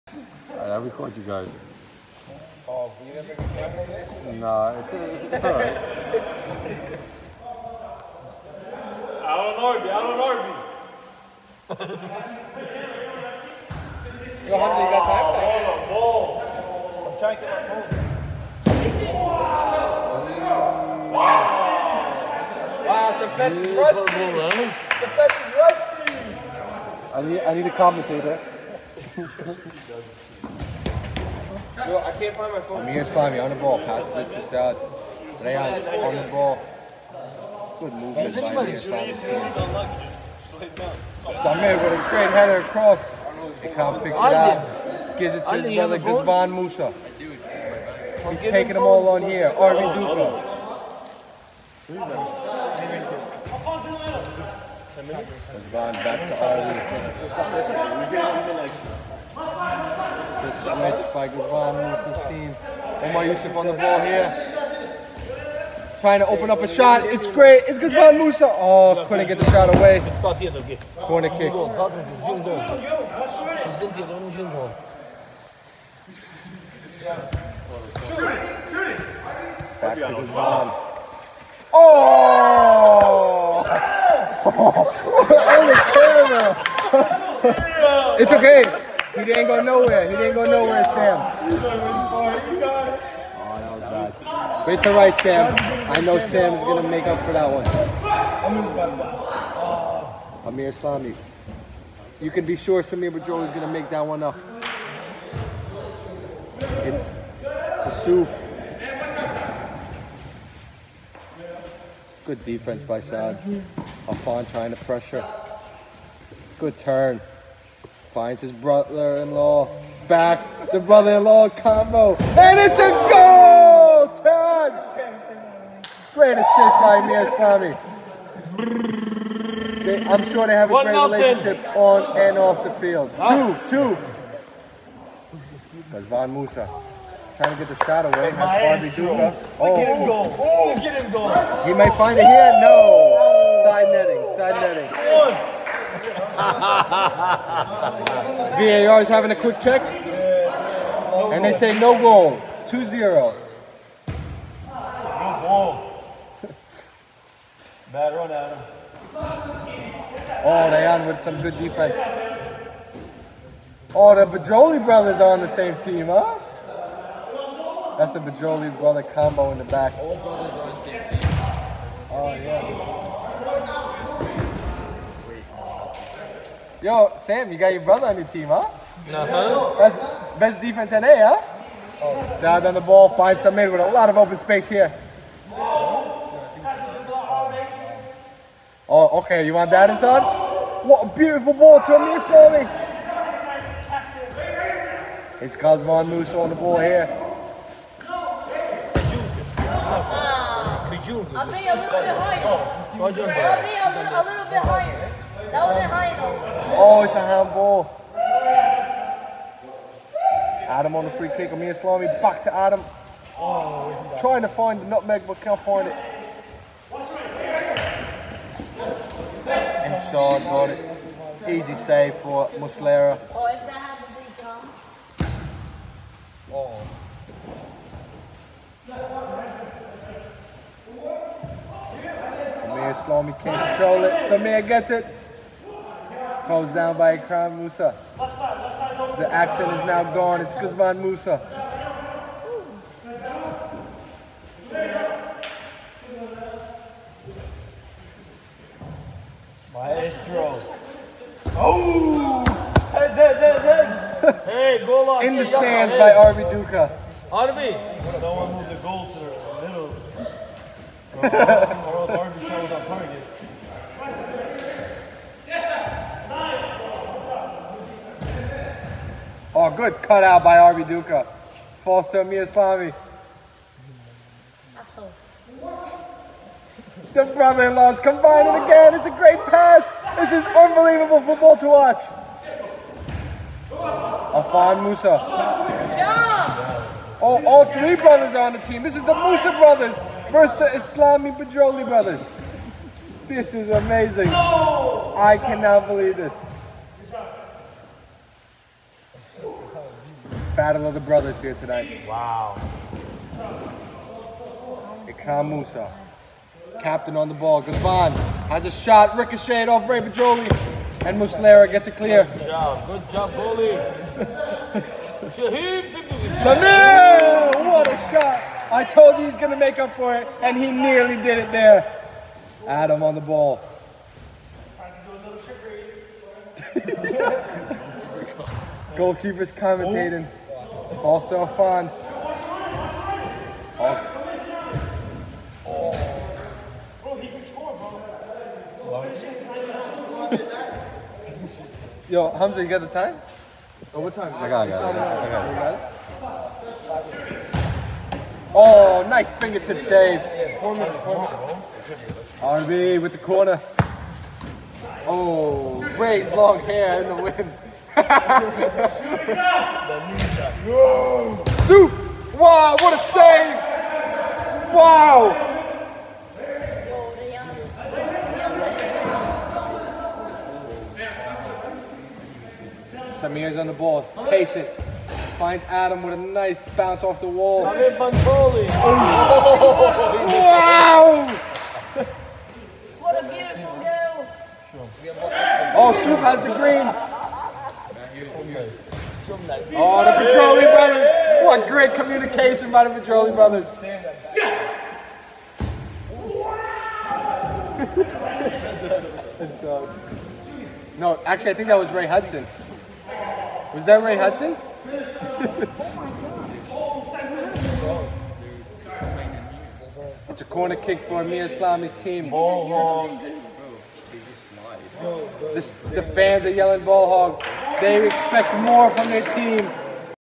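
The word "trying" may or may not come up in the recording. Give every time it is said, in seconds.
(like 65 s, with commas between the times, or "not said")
17 s, 65 s, 114 s, 137 s, 214 s.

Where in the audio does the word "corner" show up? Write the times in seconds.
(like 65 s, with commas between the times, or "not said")
70 s, 353 s, 410 s.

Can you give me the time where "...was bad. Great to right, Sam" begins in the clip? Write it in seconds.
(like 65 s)
93 s.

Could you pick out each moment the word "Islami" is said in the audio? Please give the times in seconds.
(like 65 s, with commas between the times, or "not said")
290 s, 411 s.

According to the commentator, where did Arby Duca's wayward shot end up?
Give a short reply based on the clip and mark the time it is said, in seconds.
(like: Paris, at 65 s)
In the stands, at 255 s.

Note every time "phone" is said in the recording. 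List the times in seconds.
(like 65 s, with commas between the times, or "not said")
23 s, 32 s.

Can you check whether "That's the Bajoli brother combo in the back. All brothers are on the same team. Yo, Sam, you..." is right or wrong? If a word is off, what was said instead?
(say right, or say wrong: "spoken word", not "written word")
right.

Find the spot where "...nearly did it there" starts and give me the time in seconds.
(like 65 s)
320 s.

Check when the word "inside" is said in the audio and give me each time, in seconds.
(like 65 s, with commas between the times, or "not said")
189 s.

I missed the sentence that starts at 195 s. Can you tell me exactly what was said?
It's Kazman Musa on the ball here.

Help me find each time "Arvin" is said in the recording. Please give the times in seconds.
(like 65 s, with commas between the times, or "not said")
49 s, 58 s.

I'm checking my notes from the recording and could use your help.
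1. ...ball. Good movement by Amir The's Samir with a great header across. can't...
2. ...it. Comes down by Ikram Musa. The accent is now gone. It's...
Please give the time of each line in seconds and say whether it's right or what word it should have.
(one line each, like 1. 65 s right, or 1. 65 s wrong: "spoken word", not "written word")
1. 36 s wrong: "Slimy", not "The"
2. 234 s right.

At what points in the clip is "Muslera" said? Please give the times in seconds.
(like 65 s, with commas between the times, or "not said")
222 s, 311 s.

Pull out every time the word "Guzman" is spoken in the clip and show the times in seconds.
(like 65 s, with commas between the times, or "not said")
45 s, 55 s, 61 s, 67 s, 80 s, 240 s.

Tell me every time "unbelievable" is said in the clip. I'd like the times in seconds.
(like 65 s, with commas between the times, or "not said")
280 s.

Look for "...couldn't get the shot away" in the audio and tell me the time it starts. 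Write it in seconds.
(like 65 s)
69 s.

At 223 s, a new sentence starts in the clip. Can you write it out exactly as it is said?
Oh, if that happens, he comes.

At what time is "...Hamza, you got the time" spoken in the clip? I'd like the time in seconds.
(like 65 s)
342 s.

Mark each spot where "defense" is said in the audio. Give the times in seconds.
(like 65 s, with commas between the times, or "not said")
112 s, 161 s, 180 s.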